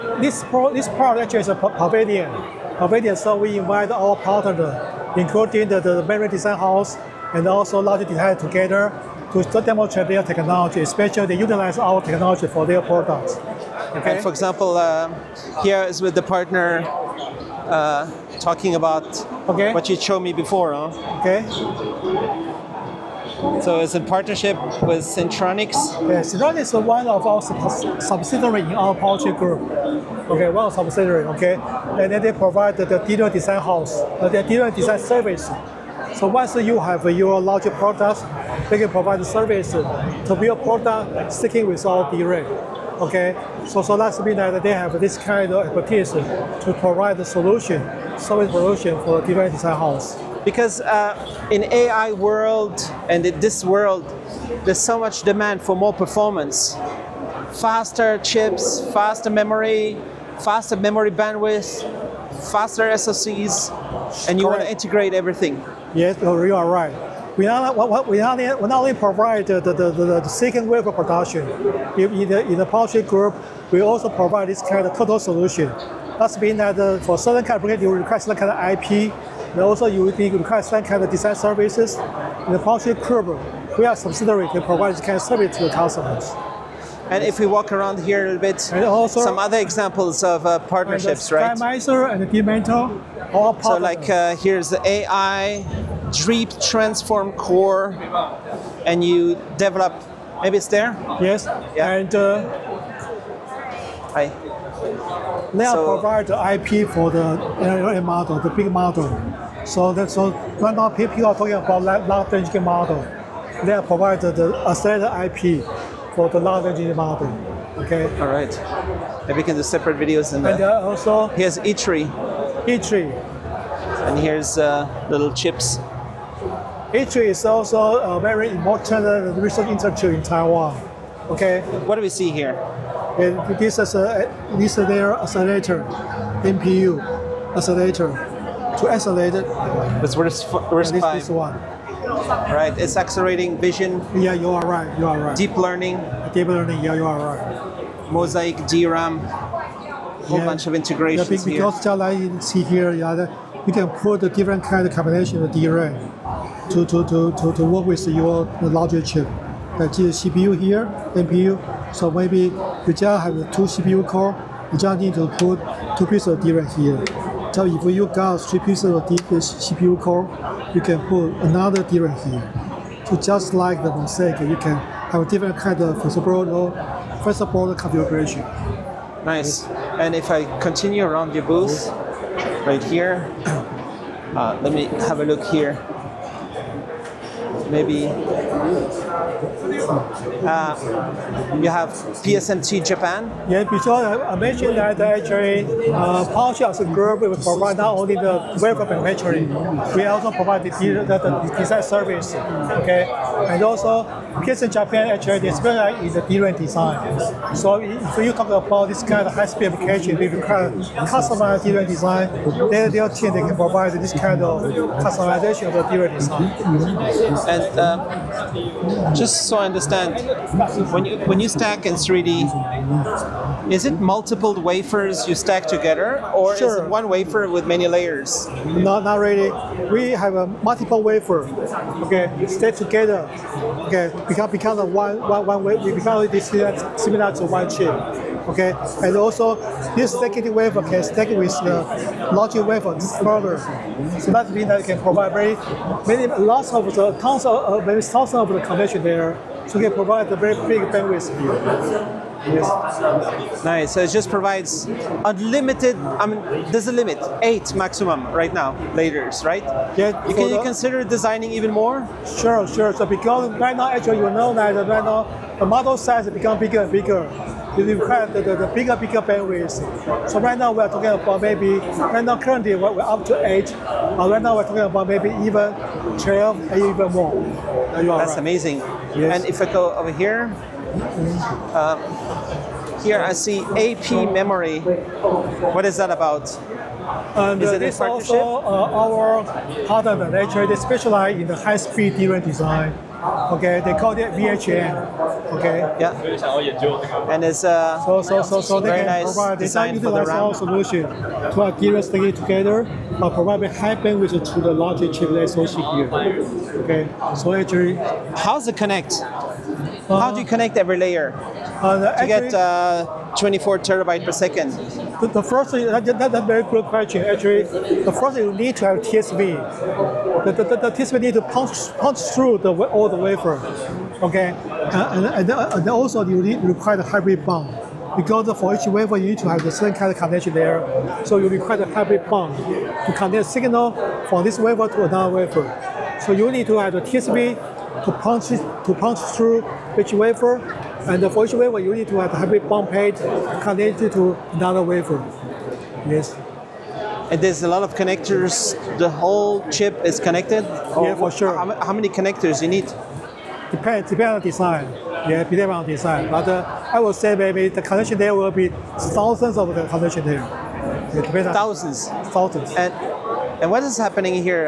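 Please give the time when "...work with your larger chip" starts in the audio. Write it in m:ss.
2:37.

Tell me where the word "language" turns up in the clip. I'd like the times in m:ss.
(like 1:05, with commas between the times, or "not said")
1:52, 1:56.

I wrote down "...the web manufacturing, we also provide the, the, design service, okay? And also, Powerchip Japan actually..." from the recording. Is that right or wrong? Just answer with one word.
wrong.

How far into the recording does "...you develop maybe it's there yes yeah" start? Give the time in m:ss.
1:39.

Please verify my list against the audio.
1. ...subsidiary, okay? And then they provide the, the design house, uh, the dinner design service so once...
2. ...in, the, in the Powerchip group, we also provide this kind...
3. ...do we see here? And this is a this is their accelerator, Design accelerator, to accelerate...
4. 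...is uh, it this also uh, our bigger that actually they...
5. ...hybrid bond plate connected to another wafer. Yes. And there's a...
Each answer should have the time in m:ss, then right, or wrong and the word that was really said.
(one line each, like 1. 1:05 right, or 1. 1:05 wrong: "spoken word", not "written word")
1. 0:30 right
2. 1:11 right
3. 2:11 wrong: "MPU", not "Design"
4. 4:47 wrong: "partner", not "bigger"
5. 5:42 right.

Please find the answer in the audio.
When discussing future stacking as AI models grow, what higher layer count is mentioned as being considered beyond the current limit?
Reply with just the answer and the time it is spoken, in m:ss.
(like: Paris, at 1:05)
12, at 4:35.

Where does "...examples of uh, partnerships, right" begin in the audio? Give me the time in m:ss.
1:29.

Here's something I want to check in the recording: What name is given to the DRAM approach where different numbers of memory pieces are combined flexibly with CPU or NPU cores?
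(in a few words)
Mosaic DRAM.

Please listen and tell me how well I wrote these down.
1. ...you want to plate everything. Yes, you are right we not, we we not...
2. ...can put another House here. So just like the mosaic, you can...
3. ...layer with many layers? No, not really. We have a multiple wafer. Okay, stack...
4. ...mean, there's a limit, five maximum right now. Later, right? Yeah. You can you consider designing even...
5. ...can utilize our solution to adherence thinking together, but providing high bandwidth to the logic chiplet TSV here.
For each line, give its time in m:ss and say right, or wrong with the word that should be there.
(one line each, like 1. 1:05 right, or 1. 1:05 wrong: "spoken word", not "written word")
1. 1:04 wrong: "integrate", not "plate"
2. 2:50 wrong: "DRAM", not "House"
3. 3:47 wrong: "wafer", not "layer"
4. 4:16 wrong: "eight", not "five"
5. 4:59 wrong: "SoC", not "TSV".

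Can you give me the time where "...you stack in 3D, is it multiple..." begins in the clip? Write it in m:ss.
3:41.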